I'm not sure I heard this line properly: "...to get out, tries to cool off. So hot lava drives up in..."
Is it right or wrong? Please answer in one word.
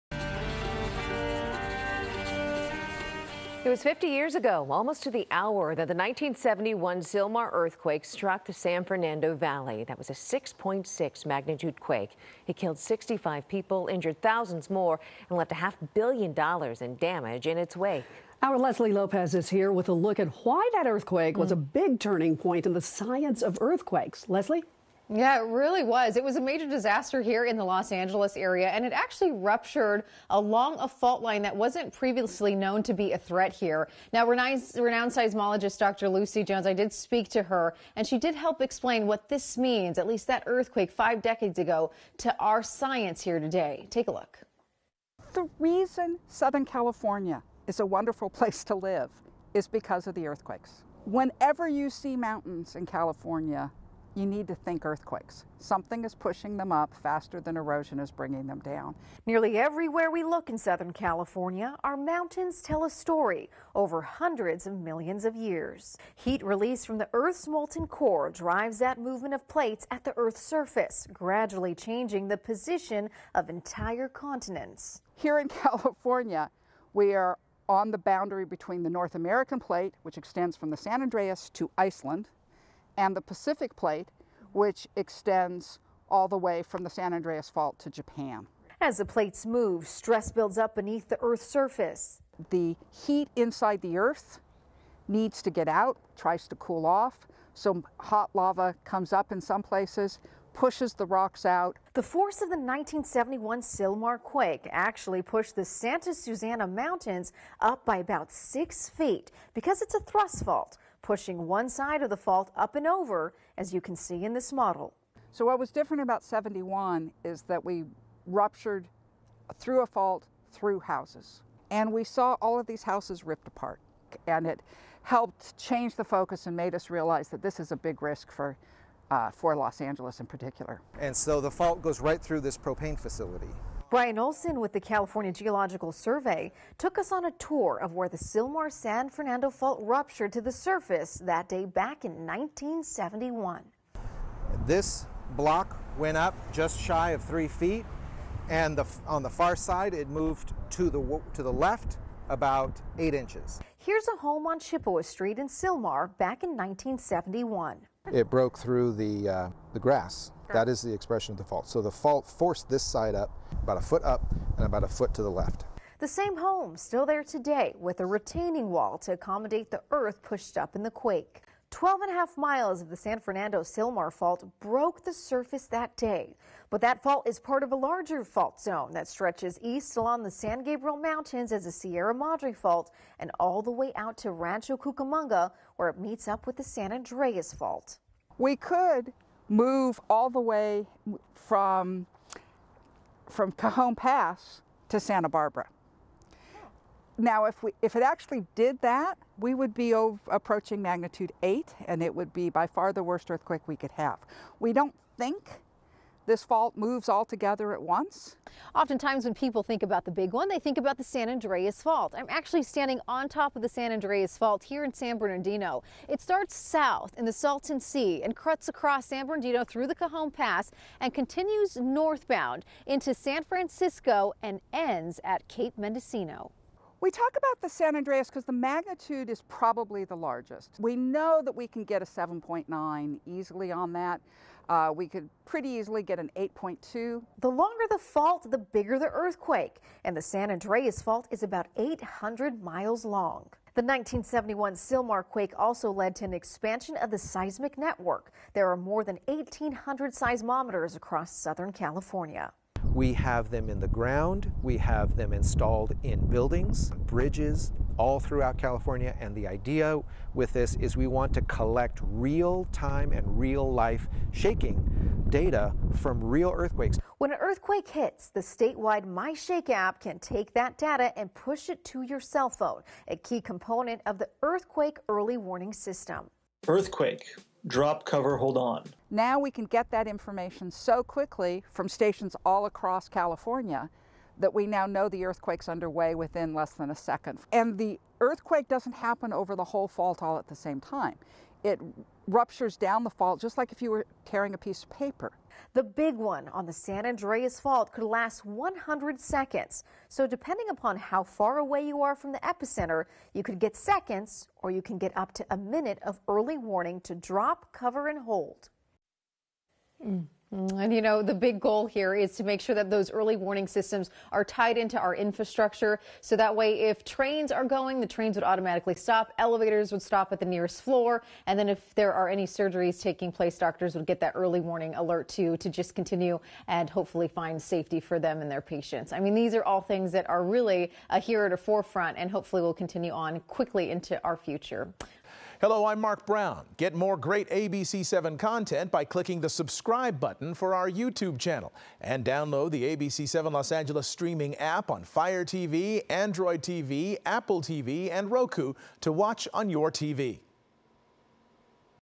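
wrong.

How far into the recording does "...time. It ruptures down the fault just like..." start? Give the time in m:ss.
4:50.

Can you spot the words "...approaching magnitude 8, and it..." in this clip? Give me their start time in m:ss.
3:20.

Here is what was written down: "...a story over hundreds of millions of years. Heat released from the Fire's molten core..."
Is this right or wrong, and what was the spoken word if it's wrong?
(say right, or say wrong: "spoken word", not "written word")
wrong: "Earth", not "Fire".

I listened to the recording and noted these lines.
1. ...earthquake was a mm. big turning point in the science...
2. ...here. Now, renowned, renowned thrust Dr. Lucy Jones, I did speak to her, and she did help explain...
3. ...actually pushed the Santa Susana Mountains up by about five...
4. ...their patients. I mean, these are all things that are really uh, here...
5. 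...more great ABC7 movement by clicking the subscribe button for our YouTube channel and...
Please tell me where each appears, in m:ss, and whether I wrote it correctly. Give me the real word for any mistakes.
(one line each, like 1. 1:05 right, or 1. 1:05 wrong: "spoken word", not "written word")
1. 0:20 right
2. 0:33 wrong: "seismologist", not "thrust"
3. 1:44 wrong: "six", not "five"
4. 5:28 right
5. 5:36 wrong: "content", not "movement".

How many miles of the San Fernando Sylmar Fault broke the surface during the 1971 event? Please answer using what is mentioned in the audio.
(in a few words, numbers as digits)
12.5 miles.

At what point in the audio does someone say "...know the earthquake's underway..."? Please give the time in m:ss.
4:44.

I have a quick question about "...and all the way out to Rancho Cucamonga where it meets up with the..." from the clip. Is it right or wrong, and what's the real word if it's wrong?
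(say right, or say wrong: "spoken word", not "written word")
right.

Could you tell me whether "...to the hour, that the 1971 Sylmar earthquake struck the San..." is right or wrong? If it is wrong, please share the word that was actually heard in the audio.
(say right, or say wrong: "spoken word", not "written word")
right.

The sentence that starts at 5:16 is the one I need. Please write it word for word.
So that way, if trains are going, the trains would automatically stop.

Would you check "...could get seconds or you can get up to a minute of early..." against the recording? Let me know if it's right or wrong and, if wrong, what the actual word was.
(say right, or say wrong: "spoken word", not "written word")
right.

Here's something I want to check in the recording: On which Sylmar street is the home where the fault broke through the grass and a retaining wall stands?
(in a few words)
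Chippewa Street.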